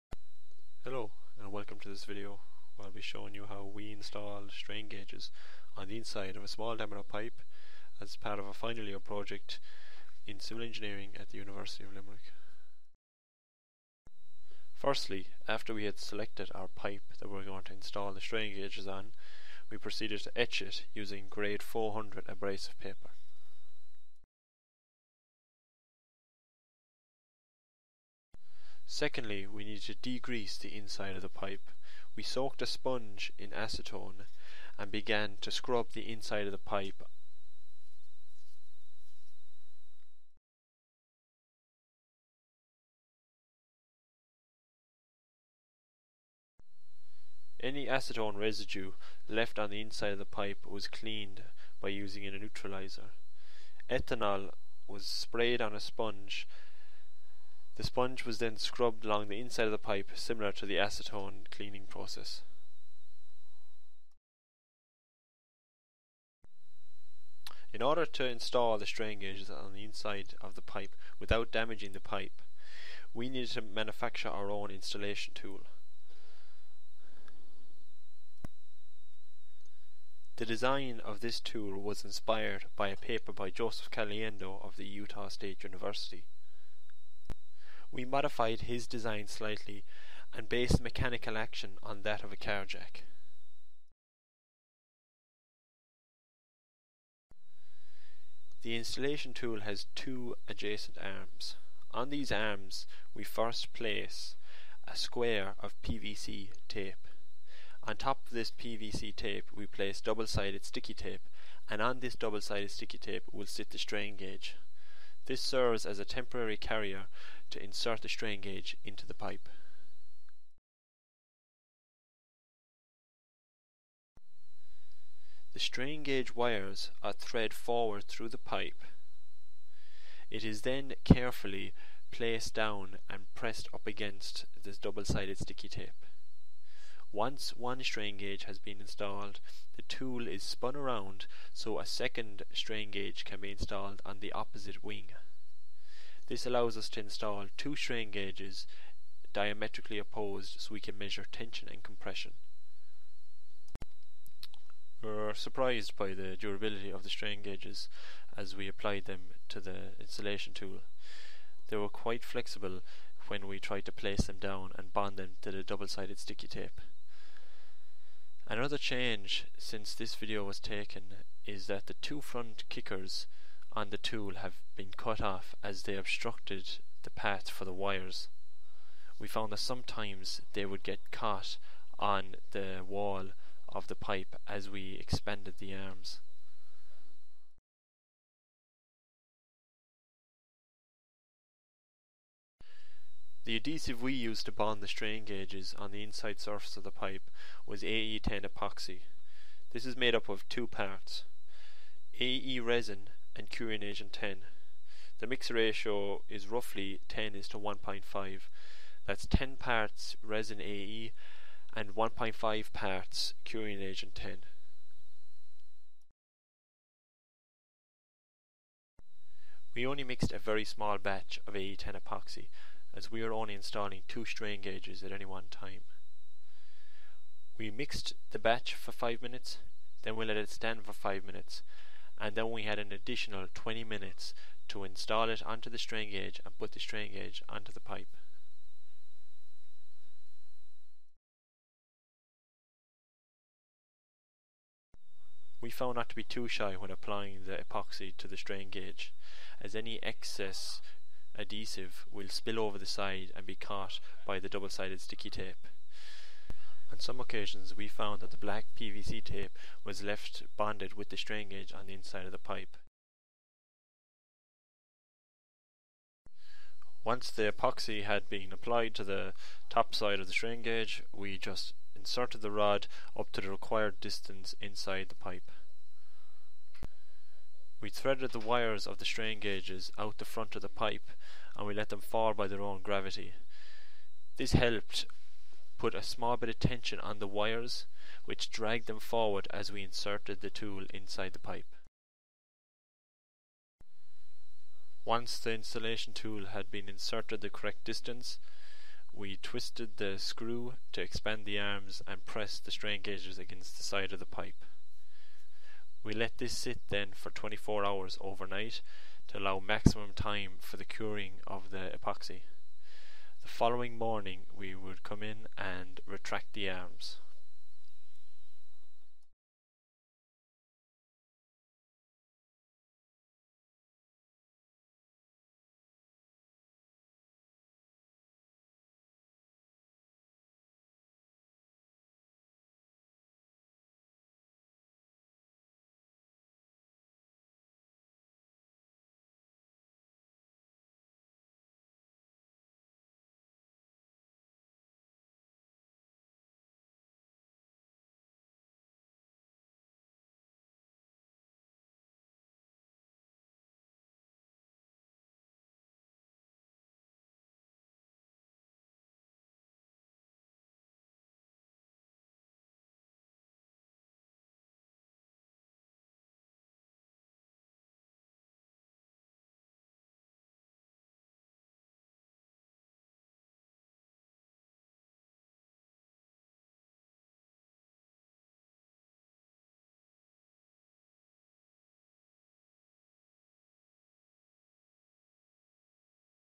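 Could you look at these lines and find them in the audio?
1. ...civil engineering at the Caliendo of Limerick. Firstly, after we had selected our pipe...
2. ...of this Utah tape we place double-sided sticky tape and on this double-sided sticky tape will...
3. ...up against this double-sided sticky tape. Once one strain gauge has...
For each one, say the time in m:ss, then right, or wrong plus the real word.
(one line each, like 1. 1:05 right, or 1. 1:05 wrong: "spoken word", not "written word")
1. 0:10 wrong: "University", not "Caliendo"
2. 1:48 wrong: "PVC", not "Utah"
3. 2:13 right.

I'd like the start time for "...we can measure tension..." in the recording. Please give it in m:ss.
2:30.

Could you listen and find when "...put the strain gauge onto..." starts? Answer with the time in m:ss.
3:56.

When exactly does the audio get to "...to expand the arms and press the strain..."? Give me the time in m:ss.
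5:00.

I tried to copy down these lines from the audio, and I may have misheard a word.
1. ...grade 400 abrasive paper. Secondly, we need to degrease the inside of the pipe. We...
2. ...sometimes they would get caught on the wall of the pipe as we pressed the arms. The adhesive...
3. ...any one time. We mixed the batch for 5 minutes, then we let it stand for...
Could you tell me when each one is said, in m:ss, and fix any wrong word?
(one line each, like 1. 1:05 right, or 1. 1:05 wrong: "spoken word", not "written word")
1. 0:21 right
2. 2:59 wrong: "expanded", not "pressed"
3. 3:45 right.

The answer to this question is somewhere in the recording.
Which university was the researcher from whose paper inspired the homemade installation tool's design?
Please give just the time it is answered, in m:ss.
1:24.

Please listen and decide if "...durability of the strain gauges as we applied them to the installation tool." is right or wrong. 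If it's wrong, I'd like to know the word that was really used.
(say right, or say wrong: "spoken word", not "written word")
right.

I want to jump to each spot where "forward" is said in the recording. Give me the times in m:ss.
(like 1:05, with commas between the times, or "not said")
2:07, 4:48.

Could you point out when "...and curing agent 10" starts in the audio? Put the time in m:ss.
3:23.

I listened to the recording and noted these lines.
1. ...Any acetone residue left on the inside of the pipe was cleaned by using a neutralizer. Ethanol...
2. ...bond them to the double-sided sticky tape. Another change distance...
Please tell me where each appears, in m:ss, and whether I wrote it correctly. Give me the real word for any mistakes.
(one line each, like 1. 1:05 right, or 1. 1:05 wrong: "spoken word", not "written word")
1. 0:47 right
2. 2:44 wrong: "since", not "distance".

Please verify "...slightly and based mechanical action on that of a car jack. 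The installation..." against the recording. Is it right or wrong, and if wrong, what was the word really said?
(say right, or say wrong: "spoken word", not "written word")
right.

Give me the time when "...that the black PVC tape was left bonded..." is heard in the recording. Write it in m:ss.
4:18.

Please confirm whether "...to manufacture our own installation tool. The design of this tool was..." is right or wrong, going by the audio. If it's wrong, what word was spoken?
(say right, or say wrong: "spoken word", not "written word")
right.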